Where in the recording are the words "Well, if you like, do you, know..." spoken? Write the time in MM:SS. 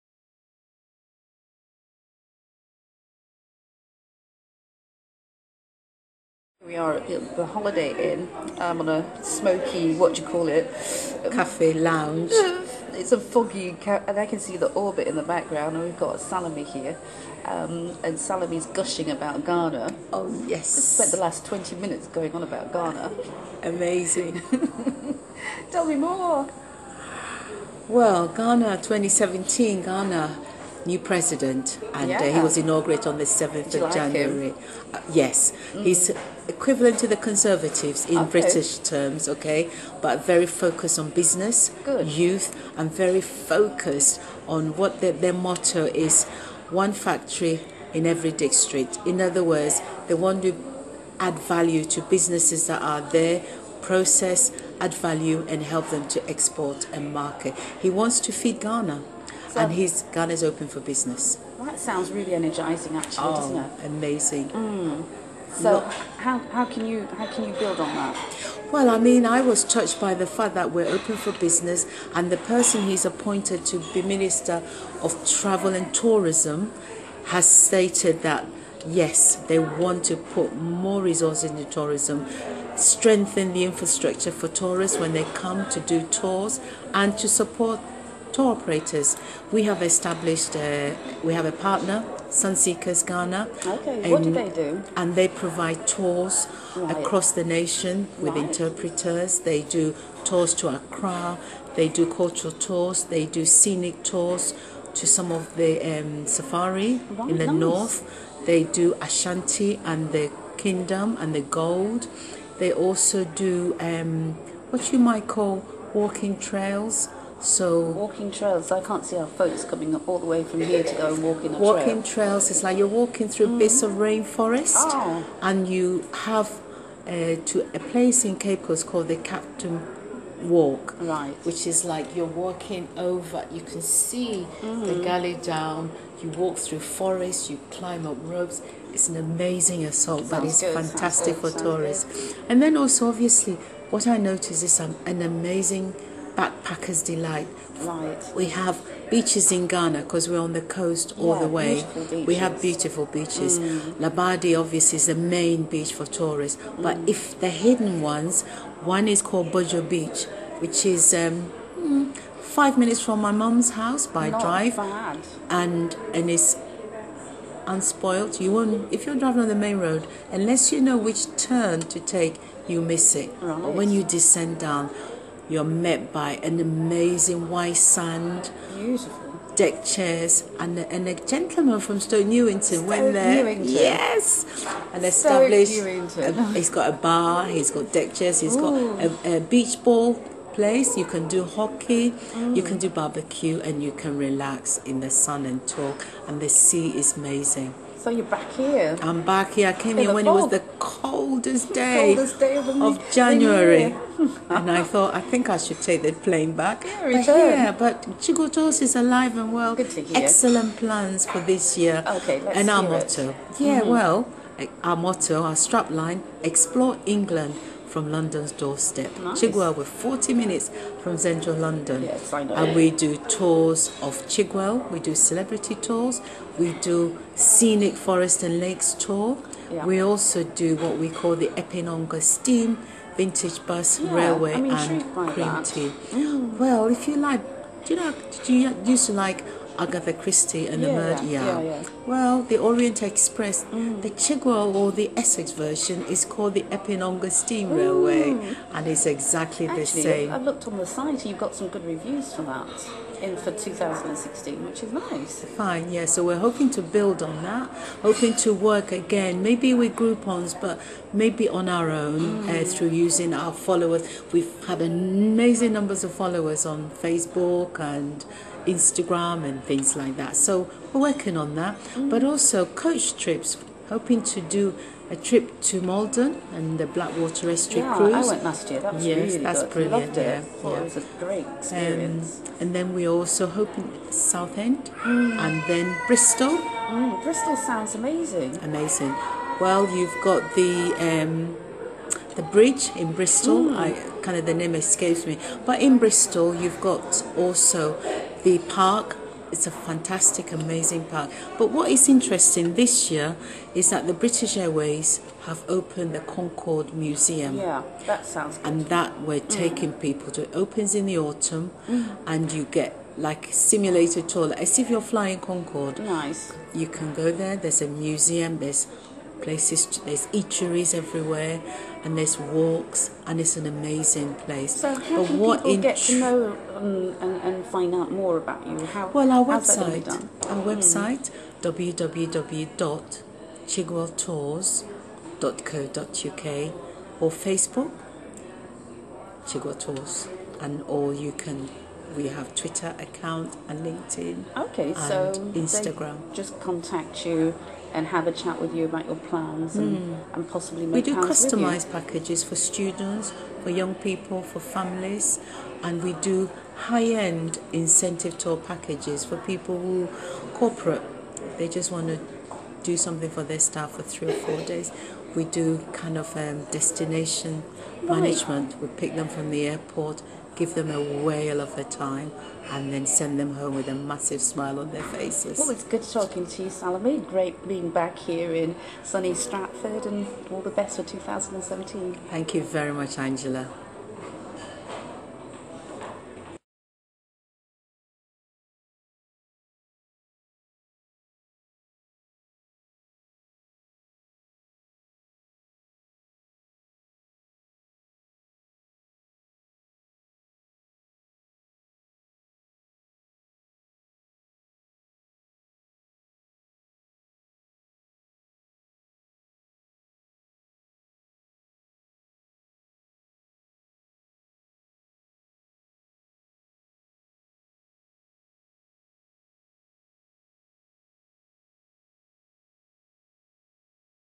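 03:56.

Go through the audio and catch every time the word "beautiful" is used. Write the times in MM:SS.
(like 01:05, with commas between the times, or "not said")
02:32, 02:58.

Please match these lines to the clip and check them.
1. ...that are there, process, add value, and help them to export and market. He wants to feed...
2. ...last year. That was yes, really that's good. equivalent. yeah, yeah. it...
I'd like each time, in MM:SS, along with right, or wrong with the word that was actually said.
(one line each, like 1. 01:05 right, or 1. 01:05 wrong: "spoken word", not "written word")
1. 00:52 right
2. 04:38 wrong: "brilliant", not "equivalent".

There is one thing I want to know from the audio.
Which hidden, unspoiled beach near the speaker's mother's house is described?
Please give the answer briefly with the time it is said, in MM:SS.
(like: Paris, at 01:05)
Bojo Beach, at 02:39.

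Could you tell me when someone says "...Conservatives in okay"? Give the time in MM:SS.
00:37.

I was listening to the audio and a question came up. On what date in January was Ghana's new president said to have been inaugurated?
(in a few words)
7th.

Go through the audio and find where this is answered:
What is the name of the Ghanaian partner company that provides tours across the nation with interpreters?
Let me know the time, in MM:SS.
01:32.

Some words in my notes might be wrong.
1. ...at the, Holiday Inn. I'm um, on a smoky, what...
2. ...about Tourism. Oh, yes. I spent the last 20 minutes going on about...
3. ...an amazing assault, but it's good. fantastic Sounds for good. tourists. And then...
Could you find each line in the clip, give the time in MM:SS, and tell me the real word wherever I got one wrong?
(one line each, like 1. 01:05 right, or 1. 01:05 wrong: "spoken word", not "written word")
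1. 00:06 right
2. 00:19 wrong: "Ghana", not "Tourism"
3. 02:19 right.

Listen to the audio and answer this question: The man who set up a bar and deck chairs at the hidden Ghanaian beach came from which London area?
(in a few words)
Stoke Newington.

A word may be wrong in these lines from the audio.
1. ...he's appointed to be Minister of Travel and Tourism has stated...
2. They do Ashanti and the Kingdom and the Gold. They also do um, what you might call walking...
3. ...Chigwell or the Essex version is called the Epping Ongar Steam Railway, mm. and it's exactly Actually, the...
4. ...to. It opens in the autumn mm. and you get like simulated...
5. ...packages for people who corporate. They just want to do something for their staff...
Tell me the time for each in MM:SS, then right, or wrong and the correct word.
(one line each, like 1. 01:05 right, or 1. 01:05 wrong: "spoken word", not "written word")
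1. 01:12 right
2. 01:48 right
3. 04:04 right
4. 05:10 right
5. 05:58 right.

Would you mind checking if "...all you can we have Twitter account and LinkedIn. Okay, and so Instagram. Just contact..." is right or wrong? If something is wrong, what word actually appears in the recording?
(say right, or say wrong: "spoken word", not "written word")
right.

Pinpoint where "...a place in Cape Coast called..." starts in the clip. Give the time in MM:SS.
02:07.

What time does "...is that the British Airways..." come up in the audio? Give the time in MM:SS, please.
05:03.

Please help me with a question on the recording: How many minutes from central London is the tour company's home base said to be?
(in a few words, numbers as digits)
40.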